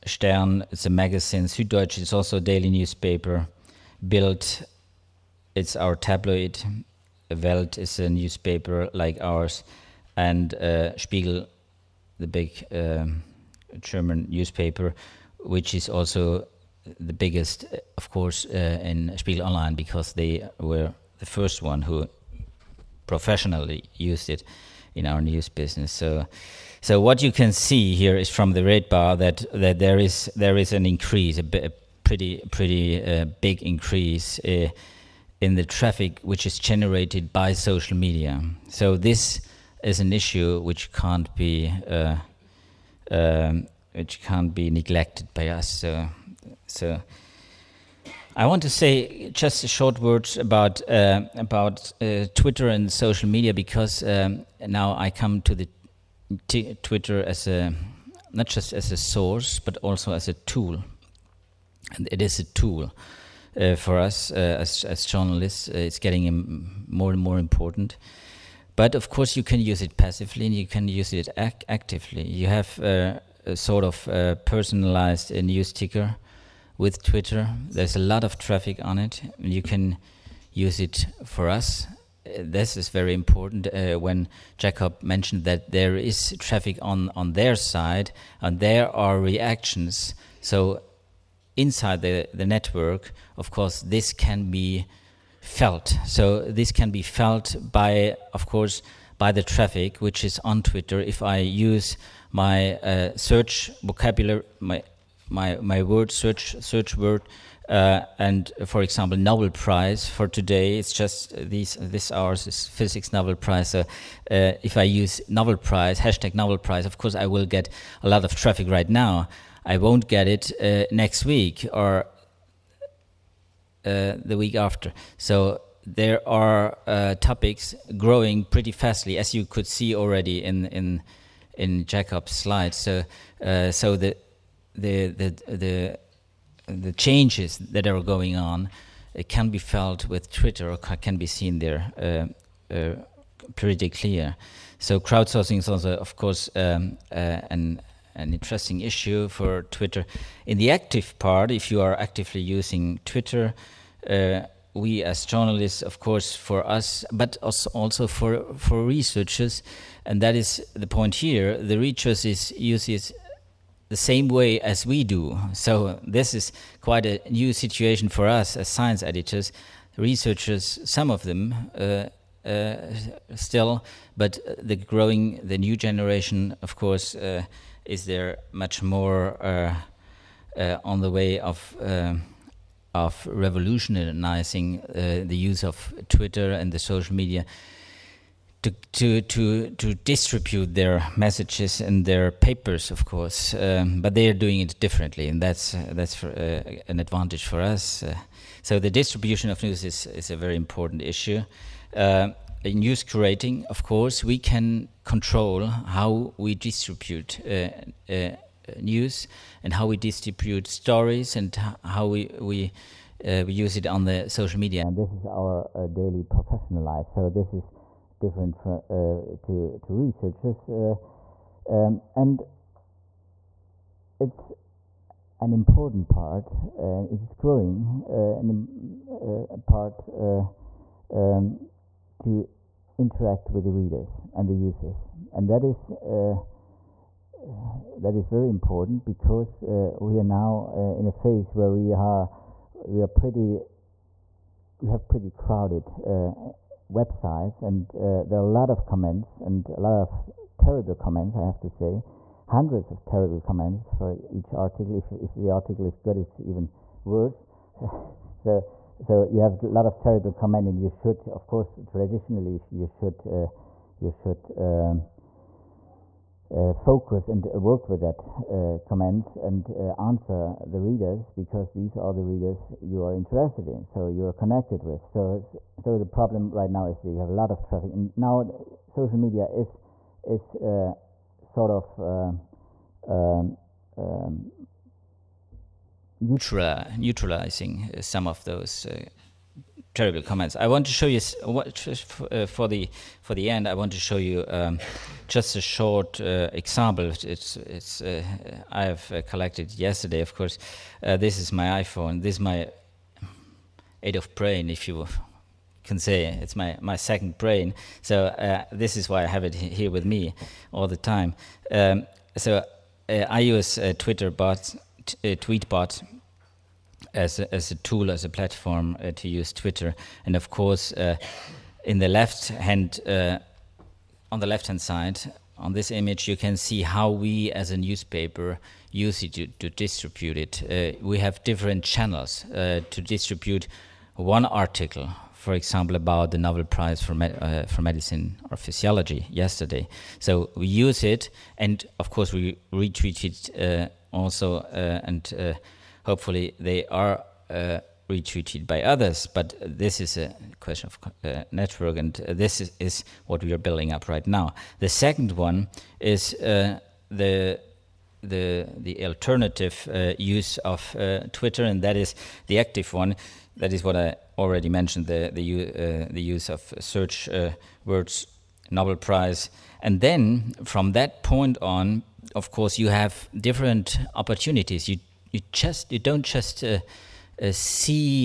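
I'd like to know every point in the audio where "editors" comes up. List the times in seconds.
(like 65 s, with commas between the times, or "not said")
169 s.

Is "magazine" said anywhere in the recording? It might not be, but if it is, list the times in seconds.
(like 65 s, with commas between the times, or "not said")
0 s.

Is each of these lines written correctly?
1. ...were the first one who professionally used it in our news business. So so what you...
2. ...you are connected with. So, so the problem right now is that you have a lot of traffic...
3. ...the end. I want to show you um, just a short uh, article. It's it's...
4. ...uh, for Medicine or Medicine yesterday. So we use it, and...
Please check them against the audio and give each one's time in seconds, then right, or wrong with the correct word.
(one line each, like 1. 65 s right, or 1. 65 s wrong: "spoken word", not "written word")
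1. 20 s right
2. 274 s right
3. 293 s wrong: "example", not "article"
4. 337 s wrong: "Physiology", not "Medicine".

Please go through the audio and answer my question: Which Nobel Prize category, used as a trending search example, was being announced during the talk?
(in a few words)
Physics.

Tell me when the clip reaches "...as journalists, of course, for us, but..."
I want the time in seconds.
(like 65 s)
155 s.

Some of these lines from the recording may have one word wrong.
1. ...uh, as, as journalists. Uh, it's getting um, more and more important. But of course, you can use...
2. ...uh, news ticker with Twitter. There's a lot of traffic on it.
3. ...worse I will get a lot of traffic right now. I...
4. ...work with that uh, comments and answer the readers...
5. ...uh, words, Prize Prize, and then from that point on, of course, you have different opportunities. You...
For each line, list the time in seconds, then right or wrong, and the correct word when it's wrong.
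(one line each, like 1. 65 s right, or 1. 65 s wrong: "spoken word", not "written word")
1. 64 s right
2. 75 s right
3. 116 s wrong: "course", not "worse"
4. 267 s right
5. 367 s wrong: "Nobel", not "Prize".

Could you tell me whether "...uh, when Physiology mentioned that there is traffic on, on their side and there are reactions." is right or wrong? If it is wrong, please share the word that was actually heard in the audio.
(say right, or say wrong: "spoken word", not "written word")
wrong: "Jacob", not "Physiology".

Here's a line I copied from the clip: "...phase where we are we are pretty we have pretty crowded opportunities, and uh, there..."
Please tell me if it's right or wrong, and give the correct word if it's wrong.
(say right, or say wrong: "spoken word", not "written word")
wrong: "websites", not "opportunities".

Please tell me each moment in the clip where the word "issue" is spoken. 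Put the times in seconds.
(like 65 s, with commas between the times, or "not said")
40 s, 148 s, 201 s.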